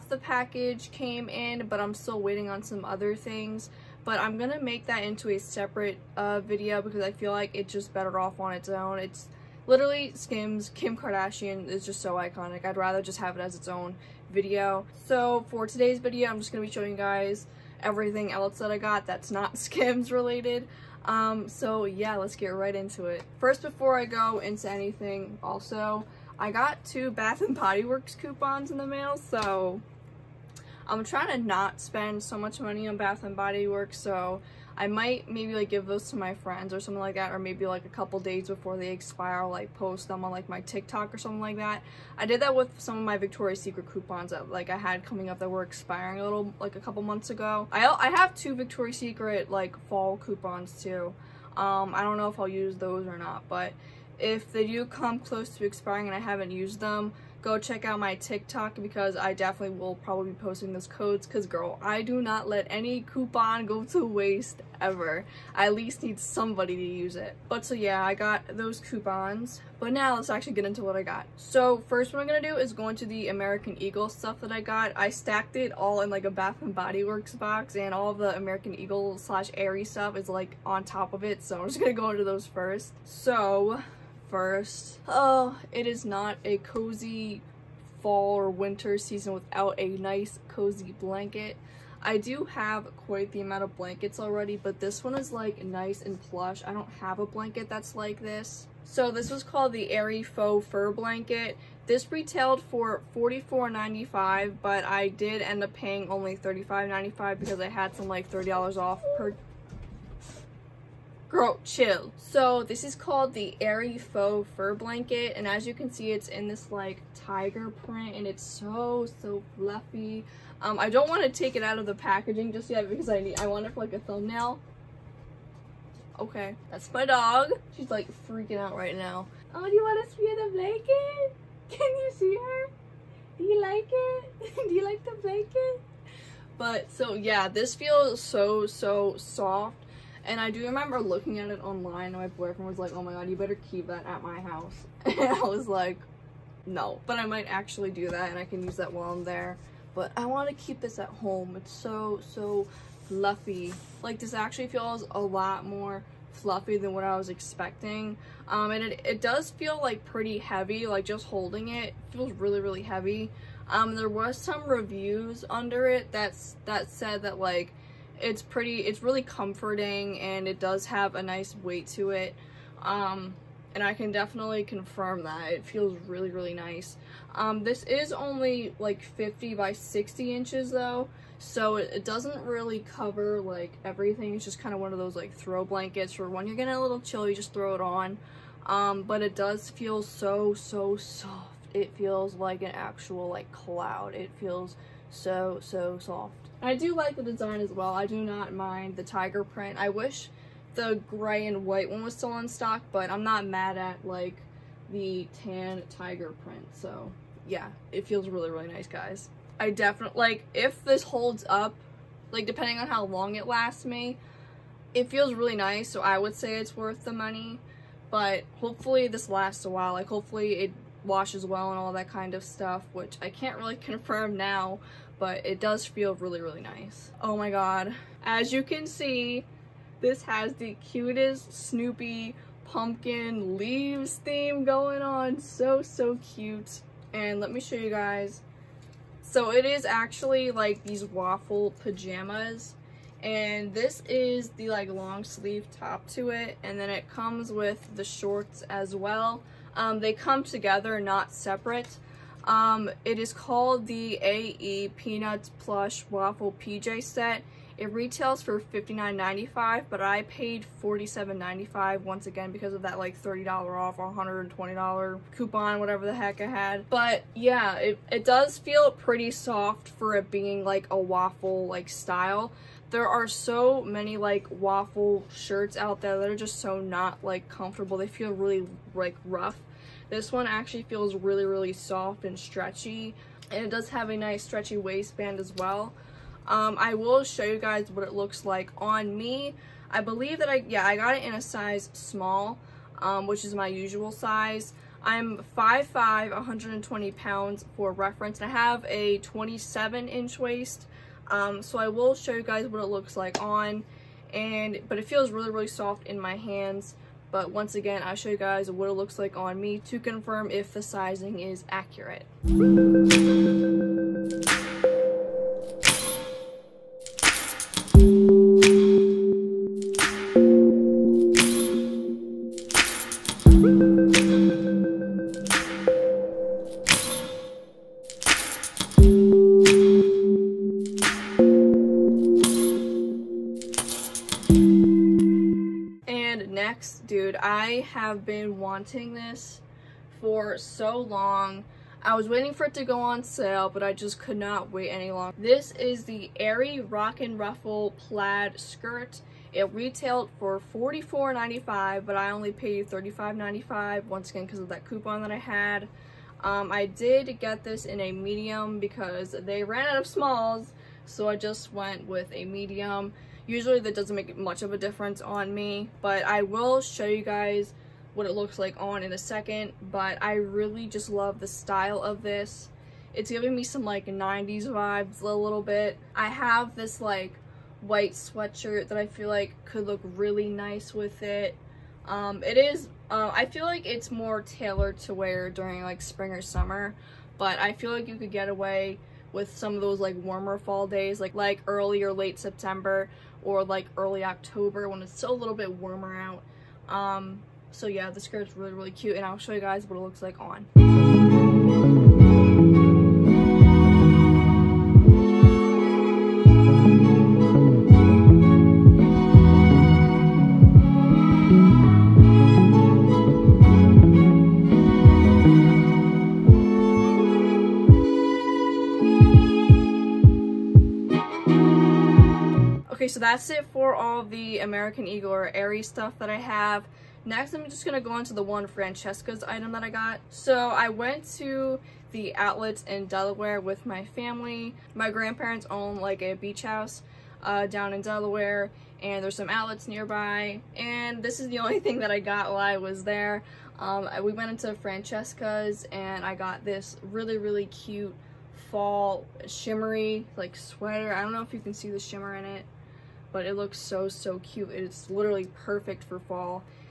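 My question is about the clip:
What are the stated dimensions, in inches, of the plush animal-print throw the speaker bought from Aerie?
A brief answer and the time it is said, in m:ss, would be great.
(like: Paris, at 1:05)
50 by 60 inches, at 2:59.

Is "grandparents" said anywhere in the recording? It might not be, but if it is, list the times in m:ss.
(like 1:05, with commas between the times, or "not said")
7:15.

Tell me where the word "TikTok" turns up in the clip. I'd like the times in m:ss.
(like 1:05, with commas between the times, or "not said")
0:40, 0:58.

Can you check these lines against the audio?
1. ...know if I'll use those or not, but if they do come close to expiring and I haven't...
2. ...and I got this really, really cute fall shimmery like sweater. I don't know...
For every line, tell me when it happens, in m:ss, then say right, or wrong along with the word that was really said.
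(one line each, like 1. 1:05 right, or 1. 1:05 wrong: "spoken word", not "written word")
1. 0:52 right
2. 7:25 right.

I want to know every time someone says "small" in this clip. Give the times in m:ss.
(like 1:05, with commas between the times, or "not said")
4:51, 6:00.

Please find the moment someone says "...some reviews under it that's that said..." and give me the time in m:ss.
2:44.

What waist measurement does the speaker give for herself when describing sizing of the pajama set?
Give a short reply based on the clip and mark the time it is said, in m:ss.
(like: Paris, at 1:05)
27 inch, at 4:59.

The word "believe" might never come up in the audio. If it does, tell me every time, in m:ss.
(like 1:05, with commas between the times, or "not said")
4:49.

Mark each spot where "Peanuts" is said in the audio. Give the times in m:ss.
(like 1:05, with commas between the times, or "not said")
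4:14.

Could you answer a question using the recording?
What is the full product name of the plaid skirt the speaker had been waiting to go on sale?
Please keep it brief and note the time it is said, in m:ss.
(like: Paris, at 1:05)
Aerie Rock and Ruffle plaid skirt, at 5:46.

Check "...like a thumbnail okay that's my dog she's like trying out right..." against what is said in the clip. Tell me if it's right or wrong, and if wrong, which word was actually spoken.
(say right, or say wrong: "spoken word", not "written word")
wrong: "freaking", not "trying".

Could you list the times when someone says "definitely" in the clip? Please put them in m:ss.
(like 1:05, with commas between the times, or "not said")
0:59, 2:54, 3:29.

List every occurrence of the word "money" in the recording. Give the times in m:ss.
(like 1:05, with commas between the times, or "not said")
0:32, 3:37.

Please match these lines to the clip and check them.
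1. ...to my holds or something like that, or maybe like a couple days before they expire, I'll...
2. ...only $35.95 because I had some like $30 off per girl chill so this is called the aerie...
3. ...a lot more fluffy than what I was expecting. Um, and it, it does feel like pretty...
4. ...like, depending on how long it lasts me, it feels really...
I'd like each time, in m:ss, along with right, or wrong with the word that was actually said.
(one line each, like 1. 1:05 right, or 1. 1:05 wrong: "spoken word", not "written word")
1. 0:36 wrong: "friends", not "holds"
2. 1:46 right
3. 2:35 right
4. 3:32 right.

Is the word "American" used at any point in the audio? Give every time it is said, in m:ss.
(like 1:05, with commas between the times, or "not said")
1:13, 1:18, 7:04.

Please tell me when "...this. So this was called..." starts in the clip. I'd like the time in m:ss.
1:38.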